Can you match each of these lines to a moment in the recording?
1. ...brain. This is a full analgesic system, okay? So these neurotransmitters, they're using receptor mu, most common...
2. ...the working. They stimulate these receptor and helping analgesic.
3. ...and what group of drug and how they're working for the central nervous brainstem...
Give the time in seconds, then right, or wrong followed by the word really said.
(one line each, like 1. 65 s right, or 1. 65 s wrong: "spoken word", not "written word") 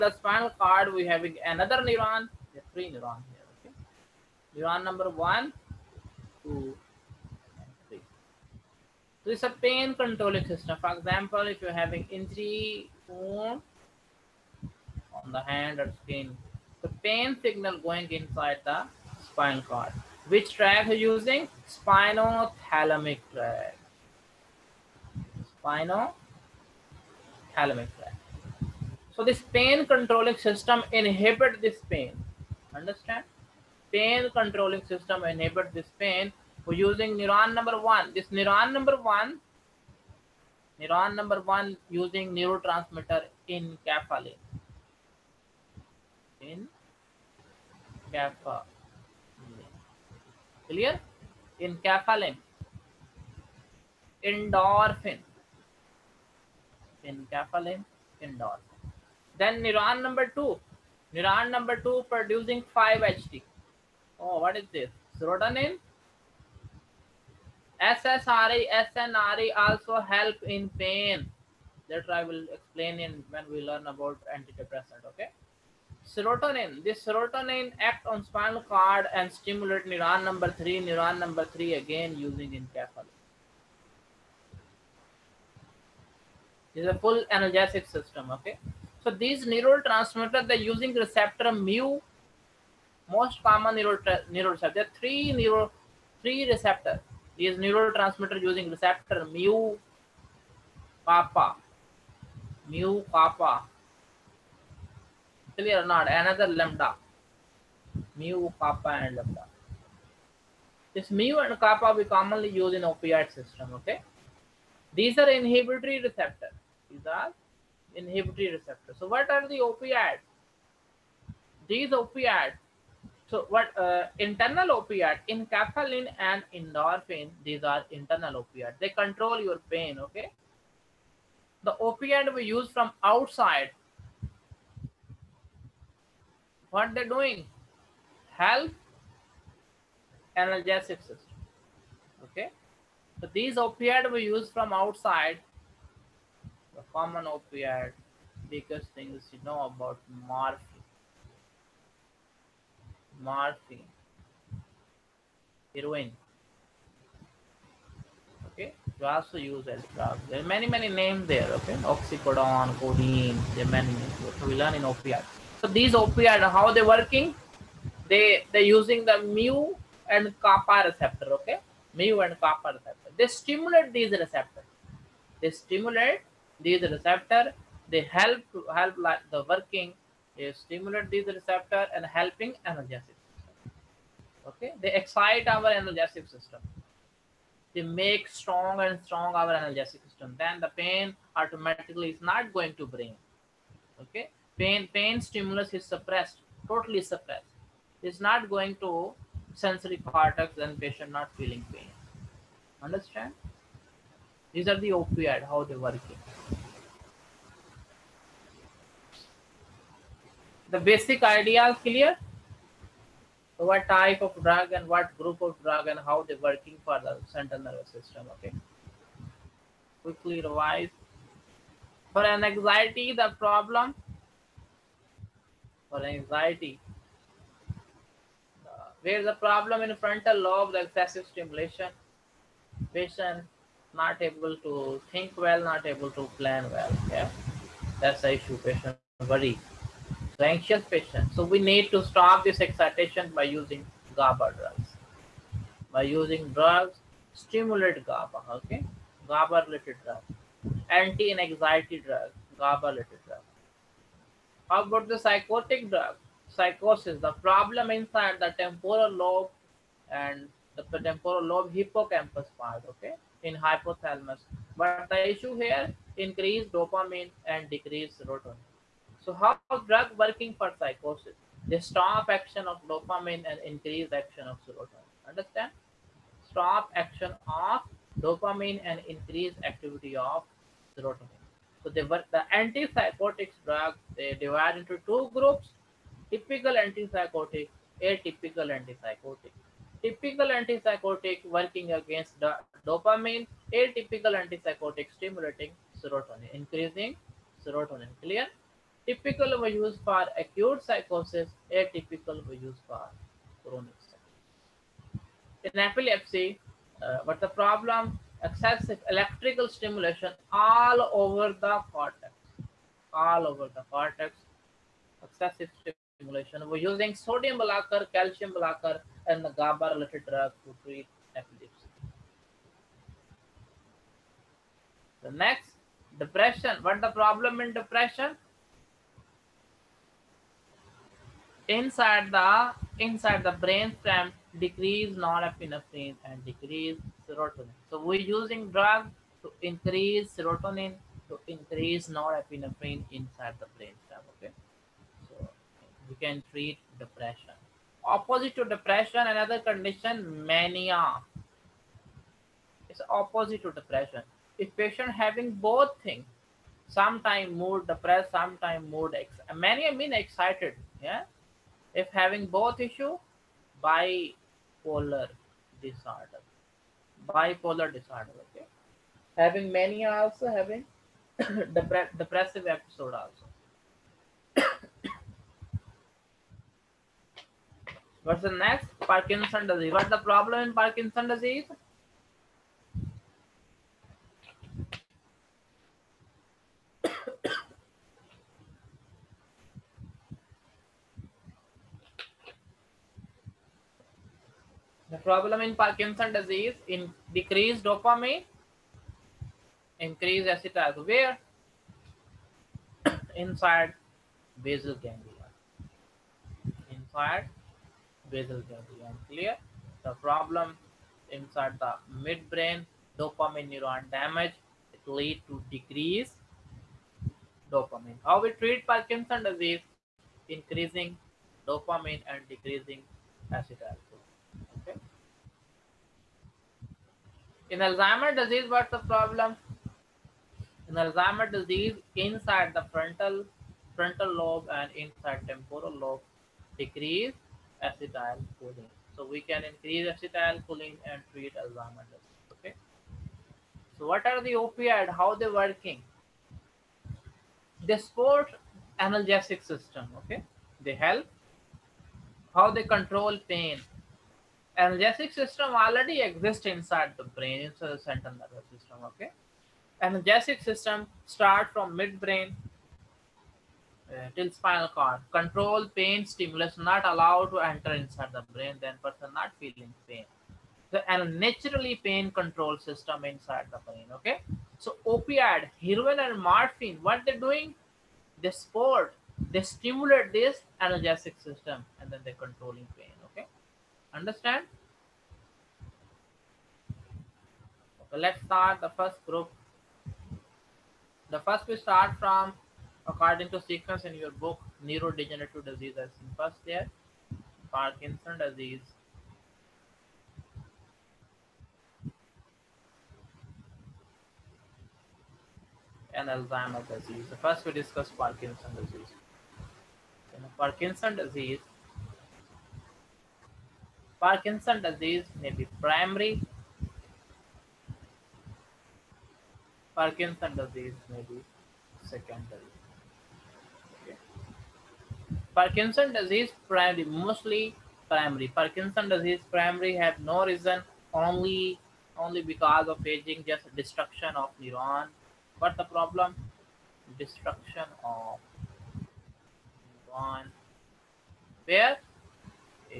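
1. 82 s wrong: "enkephalin", not "brain"
2. 179 s right
3. 214 s wrong: "system", not "brainstem".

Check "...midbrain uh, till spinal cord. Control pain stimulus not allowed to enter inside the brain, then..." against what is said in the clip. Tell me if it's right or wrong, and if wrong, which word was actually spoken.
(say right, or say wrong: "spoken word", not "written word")
right.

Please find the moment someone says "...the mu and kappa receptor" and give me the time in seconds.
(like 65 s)
169 s.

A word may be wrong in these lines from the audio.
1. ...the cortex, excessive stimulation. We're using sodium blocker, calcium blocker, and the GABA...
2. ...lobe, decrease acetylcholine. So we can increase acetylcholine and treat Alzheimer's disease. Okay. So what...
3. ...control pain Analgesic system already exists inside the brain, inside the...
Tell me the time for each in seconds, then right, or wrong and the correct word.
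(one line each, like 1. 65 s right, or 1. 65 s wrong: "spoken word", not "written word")
1. 313 s right
2. 436 s right
3. 452 s right.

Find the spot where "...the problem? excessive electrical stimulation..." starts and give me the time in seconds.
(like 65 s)
307 s.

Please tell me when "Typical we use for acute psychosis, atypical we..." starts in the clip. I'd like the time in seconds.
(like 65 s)
299 s.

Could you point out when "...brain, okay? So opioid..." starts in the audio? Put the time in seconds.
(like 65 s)
473 s.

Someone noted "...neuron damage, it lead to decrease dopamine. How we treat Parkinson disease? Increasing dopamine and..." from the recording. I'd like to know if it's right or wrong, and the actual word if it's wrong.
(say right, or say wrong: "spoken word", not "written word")
right.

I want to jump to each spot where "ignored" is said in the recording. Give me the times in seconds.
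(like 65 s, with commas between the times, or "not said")
not said.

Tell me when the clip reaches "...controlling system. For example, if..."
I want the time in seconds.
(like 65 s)
9 s.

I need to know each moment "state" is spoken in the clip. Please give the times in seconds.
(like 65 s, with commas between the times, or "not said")
not said.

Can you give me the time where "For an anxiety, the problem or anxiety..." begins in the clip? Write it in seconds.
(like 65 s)
222 s.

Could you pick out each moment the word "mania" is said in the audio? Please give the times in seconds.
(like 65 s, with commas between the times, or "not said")
350 s, 359 s.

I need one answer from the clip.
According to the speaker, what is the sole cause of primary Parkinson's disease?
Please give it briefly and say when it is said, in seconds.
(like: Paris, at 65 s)
Aging, at 533 s.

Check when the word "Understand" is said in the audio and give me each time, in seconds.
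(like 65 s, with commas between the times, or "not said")
32 s, 202 s, 275 s, 484 s.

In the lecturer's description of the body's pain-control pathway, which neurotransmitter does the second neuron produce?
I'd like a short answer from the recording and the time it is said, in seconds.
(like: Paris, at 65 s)
5-HT (serotonin), at 62 s.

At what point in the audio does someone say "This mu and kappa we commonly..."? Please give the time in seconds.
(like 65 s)
110 s.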